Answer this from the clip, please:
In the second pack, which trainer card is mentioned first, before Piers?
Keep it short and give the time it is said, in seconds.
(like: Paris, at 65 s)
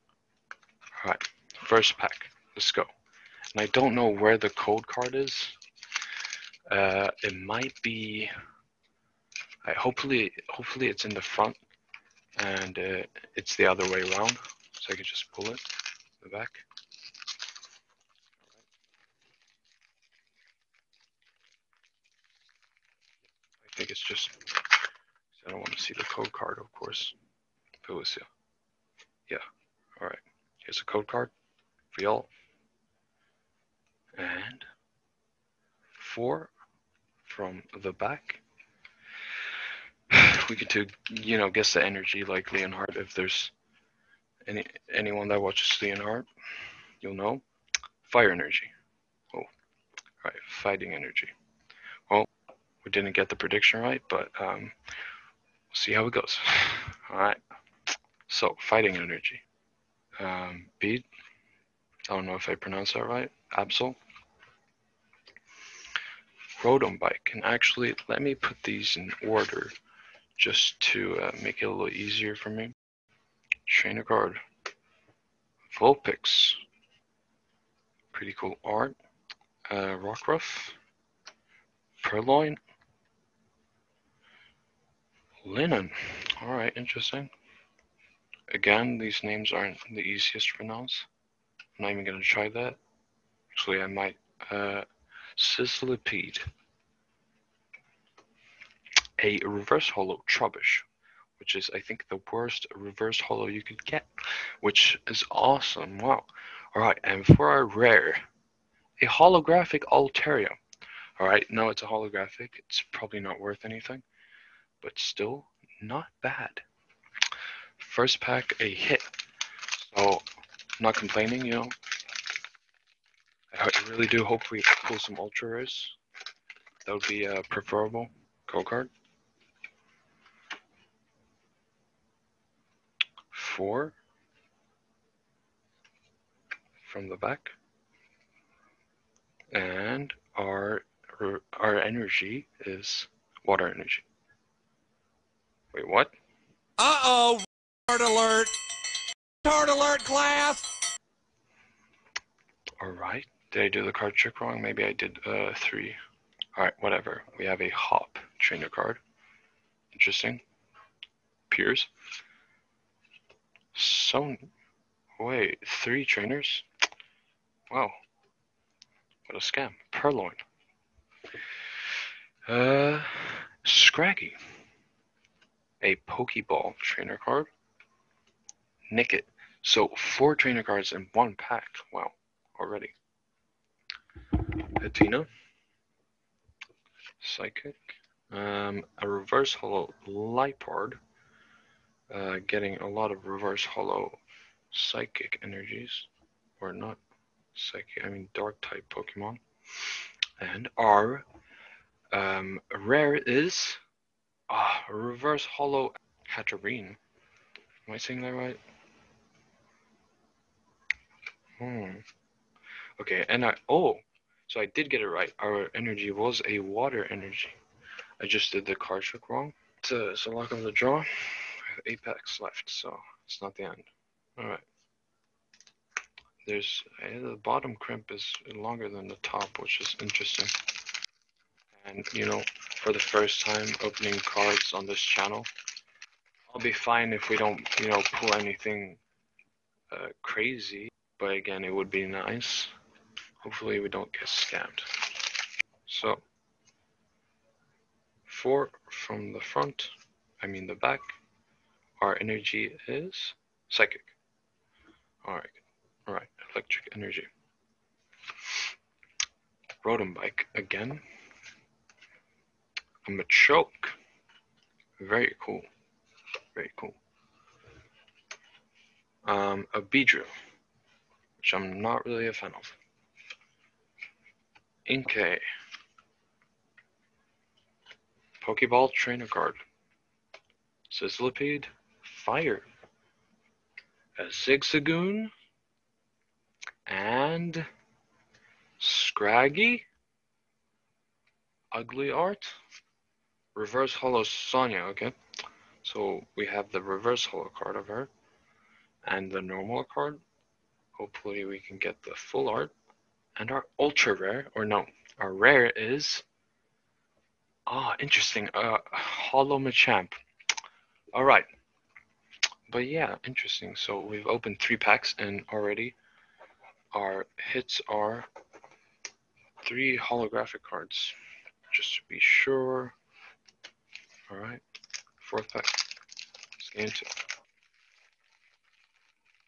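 Hop, at 157 s.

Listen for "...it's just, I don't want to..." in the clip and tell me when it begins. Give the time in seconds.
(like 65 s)
23 s.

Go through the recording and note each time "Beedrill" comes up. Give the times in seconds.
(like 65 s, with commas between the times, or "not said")
269 s.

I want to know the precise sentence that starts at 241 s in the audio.
But again, it would be nice.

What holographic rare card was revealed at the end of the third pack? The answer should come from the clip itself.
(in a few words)
Machamp.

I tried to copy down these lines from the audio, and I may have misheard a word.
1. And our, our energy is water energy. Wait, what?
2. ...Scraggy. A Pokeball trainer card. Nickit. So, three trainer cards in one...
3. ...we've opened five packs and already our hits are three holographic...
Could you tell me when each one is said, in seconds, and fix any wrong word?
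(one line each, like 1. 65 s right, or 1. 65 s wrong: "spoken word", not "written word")
1. 139 s right
2. 173 s wrong: "four", not "three"
3. 313 s wrong: "three", not "five".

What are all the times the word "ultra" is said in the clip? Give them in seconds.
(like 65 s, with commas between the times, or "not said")
125 s, 303 s.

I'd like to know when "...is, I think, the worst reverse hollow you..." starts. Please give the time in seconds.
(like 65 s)
101 s.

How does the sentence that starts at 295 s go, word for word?
So we have the reverse hollow card of her and the normal card.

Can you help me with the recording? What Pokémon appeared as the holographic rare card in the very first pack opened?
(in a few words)
Altaria.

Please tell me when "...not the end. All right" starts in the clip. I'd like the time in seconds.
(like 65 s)
223 s.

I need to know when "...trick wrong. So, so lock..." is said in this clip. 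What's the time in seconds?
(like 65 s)
219 s.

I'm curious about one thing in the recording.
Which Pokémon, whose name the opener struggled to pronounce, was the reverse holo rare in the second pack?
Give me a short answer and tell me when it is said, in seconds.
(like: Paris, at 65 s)
Hatterene, at 206 s.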